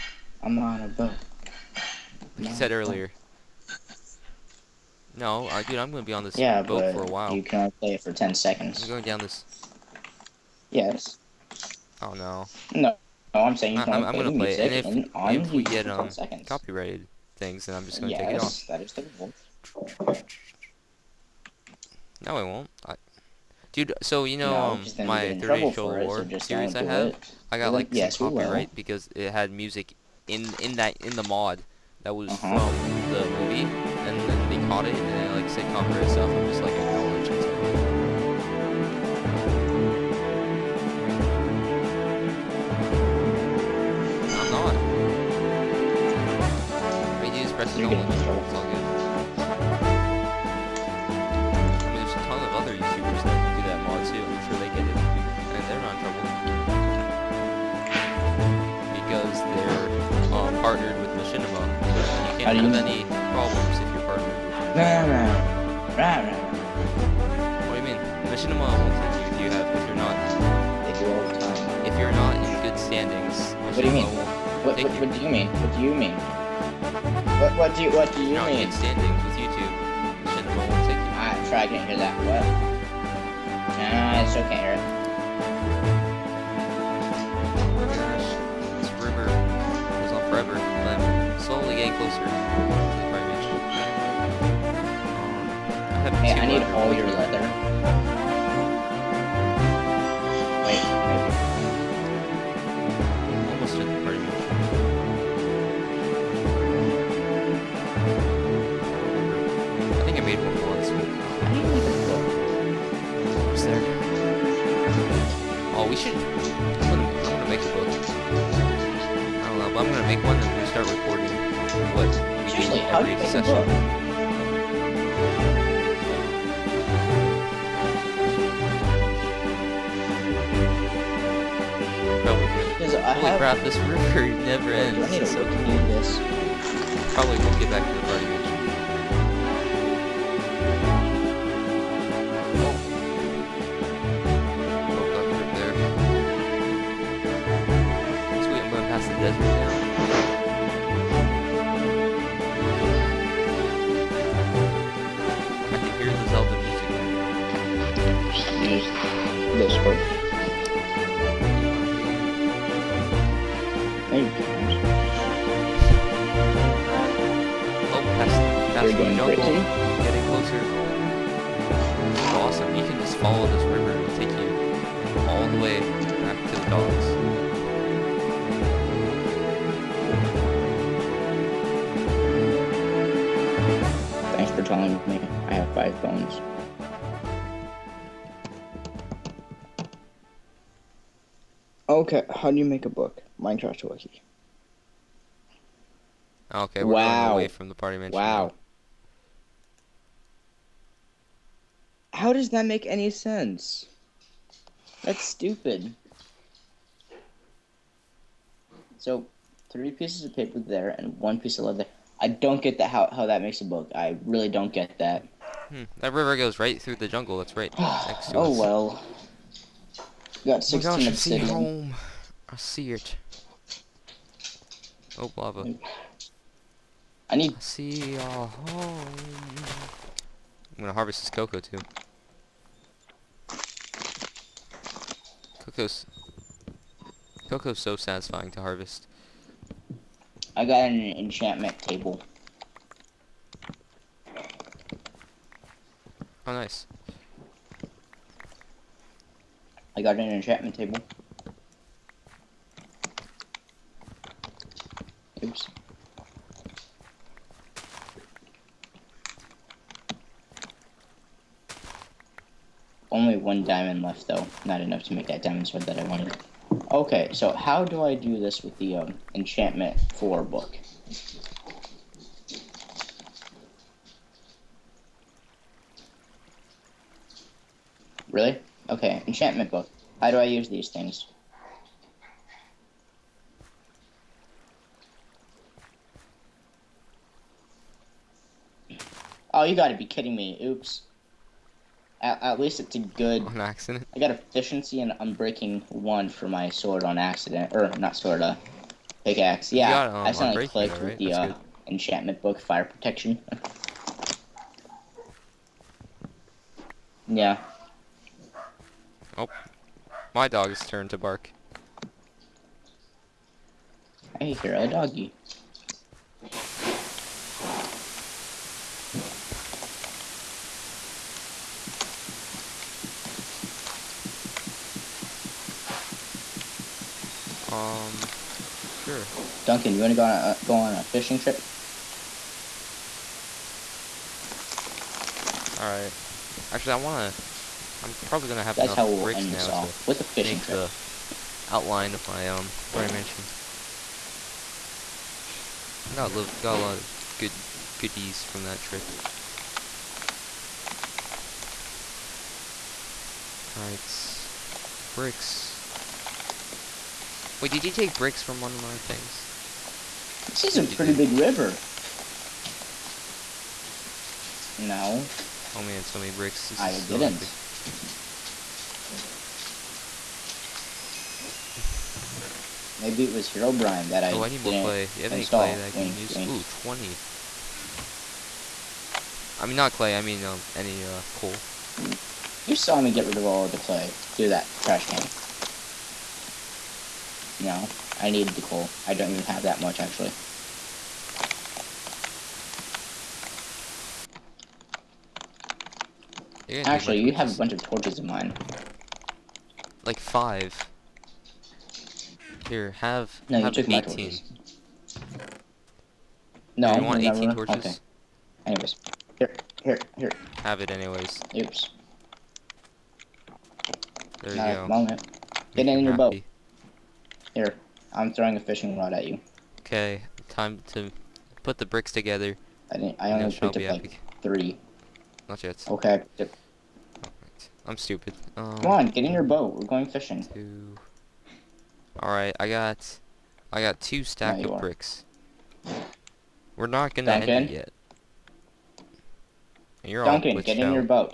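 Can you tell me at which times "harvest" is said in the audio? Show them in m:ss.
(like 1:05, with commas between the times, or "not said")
3:50, 3:58.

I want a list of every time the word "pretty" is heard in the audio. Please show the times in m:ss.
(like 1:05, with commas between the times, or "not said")
6:00.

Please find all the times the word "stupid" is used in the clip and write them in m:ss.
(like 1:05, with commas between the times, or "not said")
3:25, 7:07.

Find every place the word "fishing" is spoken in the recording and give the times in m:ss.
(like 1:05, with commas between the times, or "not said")
5:31, 5:40, 6:58, 7:10.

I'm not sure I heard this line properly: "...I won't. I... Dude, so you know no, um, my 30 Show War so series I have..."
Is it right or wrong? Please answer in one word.
right.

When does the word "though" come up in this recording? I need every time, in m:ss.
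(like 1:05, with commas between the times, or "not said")
4:24.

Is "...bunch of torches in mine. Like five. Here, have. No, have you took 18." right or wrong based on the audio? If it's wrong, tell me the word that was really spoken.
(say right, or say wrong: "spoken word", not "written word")
right.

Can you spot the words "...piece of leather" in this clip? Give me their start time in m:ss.
3:31.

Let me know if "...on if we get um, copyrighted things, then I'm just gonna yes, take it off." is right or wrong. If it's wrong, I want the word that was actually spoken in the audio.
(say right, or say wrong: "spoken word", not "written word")
right.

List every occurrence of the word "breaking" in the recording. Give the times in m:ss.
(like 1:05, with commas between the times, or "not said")
4:55.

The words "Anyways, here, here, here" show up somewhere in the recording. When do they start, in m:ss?
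6:48.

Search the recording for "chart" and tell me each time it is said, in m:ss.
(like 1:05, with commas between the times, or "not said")
not said.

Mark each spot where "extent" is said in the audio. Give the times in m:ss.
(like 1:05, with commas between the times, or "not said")
not said.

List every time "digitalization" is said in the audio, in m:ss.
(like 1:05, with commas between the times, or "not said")
not said.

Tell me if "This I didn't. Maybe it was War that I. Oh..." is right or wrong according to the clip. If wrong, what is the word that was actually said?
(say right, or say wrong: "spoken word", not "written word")
wrong: "Herobrine", not "War".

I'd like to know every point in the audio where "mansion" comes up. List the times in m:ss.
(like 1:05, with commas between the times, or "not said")
3:17.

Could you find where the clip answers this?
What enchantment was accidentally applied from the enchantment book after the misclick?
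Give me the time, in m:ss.
5:02.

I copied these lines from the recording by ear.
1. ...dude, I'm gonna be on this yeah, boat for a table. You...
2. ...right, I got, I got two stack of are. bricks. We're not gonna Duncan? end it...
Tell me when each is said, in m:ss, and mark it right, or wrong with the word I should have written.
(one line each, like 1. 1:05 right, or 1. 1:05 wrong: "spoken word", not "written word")
1. 0:05 wrong: "while", not "table"
2. 7:12 right.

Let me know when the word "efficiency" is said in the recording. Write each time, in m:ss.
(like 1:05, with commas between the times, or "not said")
4:54.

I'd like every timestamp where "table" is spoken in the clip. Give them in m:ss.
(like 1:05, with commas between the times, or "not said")
4:01, 4:10.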